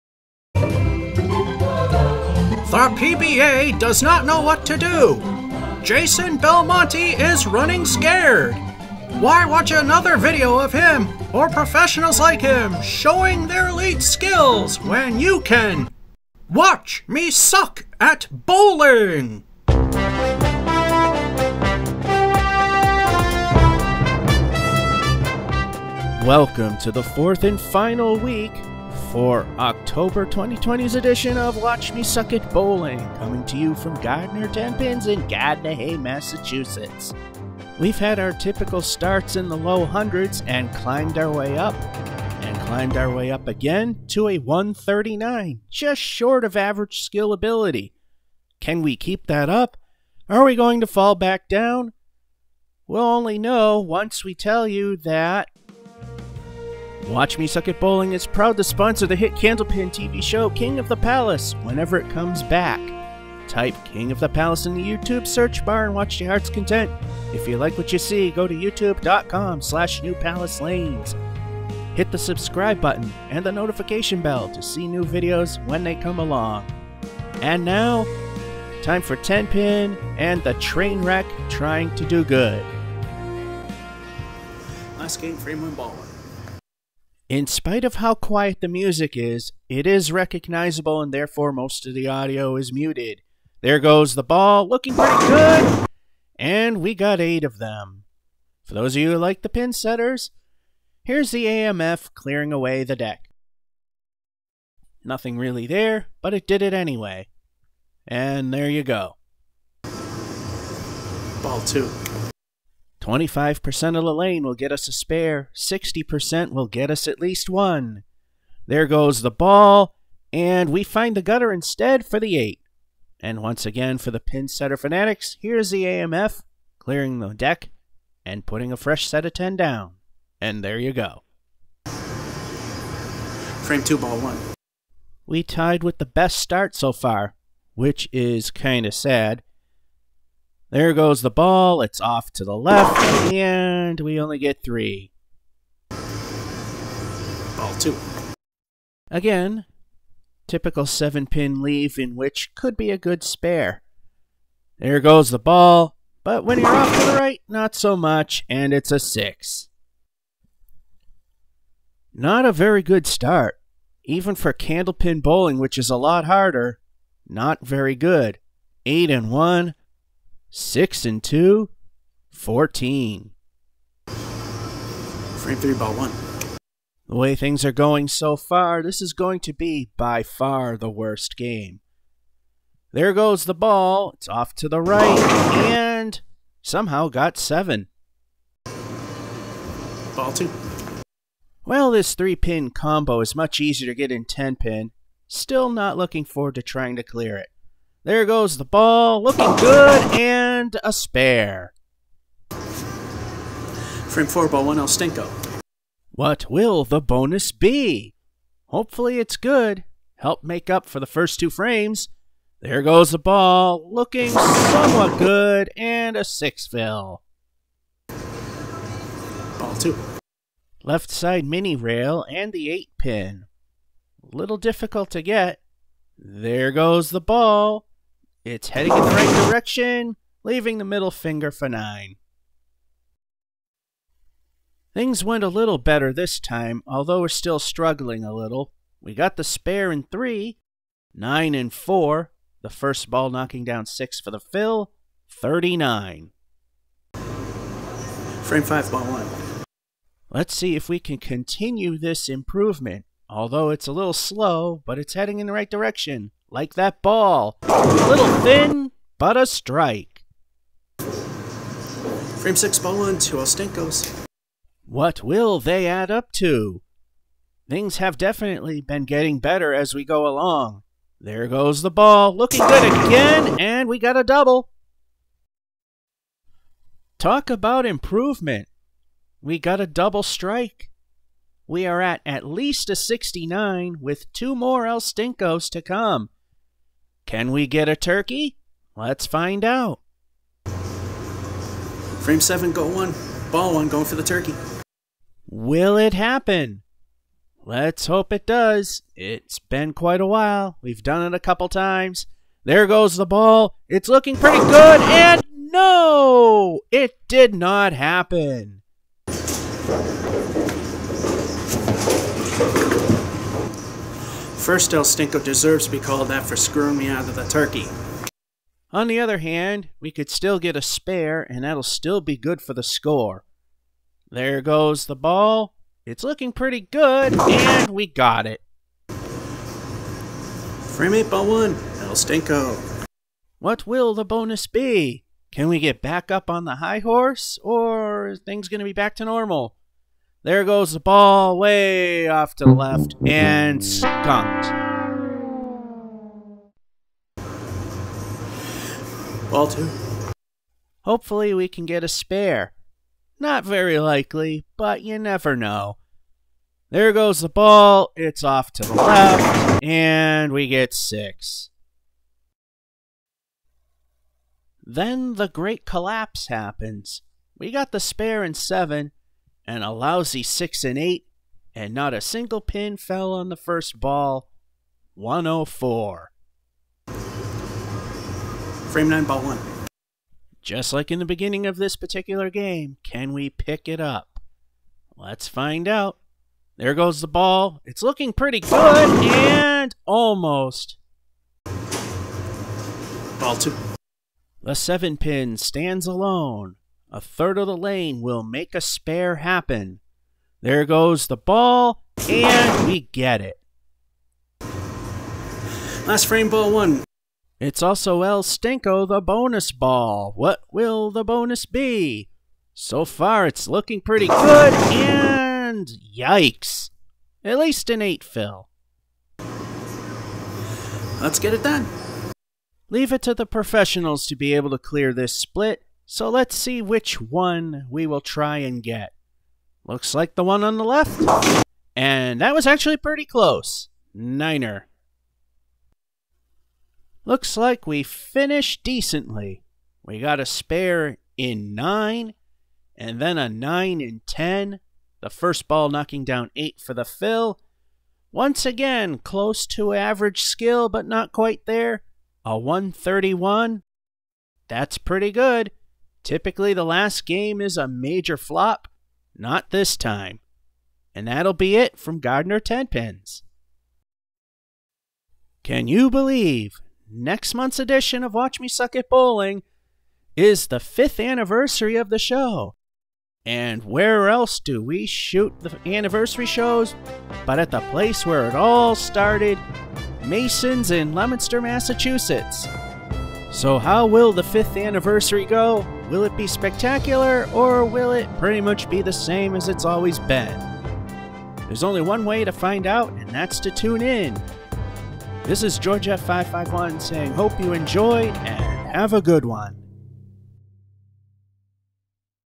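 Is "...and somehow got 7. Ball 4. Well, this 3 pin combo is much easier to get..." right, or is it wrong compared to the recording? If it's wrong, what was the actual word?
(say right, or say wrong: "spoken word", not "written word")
wrong: "2", not "4".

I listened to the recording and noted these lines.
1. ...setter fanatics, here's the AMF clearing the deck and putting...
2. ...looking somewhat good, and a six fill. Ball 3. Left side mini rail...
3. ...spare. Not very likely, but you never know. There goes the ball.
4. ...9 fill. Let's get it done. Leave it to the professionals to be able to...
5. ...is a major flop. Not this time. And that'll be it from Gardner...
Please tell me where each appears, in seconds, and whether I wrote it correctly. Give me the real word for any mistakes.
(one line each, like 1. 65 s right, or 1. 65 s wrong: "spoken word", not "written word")
1. 124 s right
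2. 213 s wrong: "2", not "3"
3. 352 s right
4. 418 s wrong: "8", not "9"
5. 457 s right.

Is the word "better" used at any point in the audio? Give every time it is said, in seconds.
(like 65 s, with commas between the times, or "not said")
235 s, 269 s.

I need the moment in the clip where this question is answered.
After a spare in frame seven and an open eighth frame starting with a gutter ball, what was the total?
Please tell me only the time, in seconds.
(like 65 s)
375 s.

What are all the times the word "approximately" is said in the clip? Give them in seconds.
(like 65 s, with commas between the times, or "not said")
not said.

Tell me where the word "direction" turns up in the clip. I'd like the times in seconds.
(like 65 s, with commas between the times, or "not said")
229 s, 255 s.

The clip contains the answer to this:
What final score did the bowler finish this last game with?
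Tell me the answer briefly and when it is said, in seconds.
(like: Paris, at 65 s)
131, at 452 s.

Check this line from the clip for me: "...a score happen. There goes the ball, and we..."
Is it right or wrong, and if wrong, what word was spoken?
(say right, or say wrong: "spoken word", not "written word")
wrong: "spare", not "score".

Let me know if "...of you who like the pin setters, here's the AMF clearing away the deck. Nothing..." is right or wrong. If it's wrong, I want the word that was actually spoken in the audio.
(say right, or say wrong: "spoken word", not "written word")
right.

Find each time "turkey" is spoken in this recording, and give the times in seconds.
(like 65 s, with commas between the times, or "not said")
287 s, 294 s, 317 s.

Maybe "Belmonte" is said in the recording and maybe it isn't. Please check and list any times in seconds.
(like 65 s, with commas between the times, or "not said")
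6 s.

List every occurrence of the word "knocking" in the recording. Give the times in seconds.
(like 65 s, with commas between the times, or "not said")
243 s, 445 s.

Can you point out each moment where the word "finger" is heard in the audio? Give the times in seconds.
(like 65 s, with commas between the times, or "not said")
231 s.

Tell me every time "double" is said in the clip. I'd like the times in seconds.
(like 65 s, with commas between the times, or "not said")
274 s, 279 s.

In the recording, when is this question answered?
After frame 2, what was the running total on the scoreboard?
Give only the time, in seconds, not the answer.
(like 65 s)
172 s.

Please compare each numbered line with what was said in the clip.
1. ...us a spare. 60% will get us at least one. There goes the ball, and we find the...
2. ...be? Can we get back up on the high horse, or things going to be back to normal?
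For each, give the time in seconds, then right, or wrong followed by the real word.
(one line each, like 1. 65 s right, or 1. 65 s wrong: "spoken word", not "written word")
1. 114 s right
2. 334 s right.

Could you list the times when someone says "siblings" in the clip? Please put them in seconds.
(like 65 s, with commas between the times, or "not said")
not said.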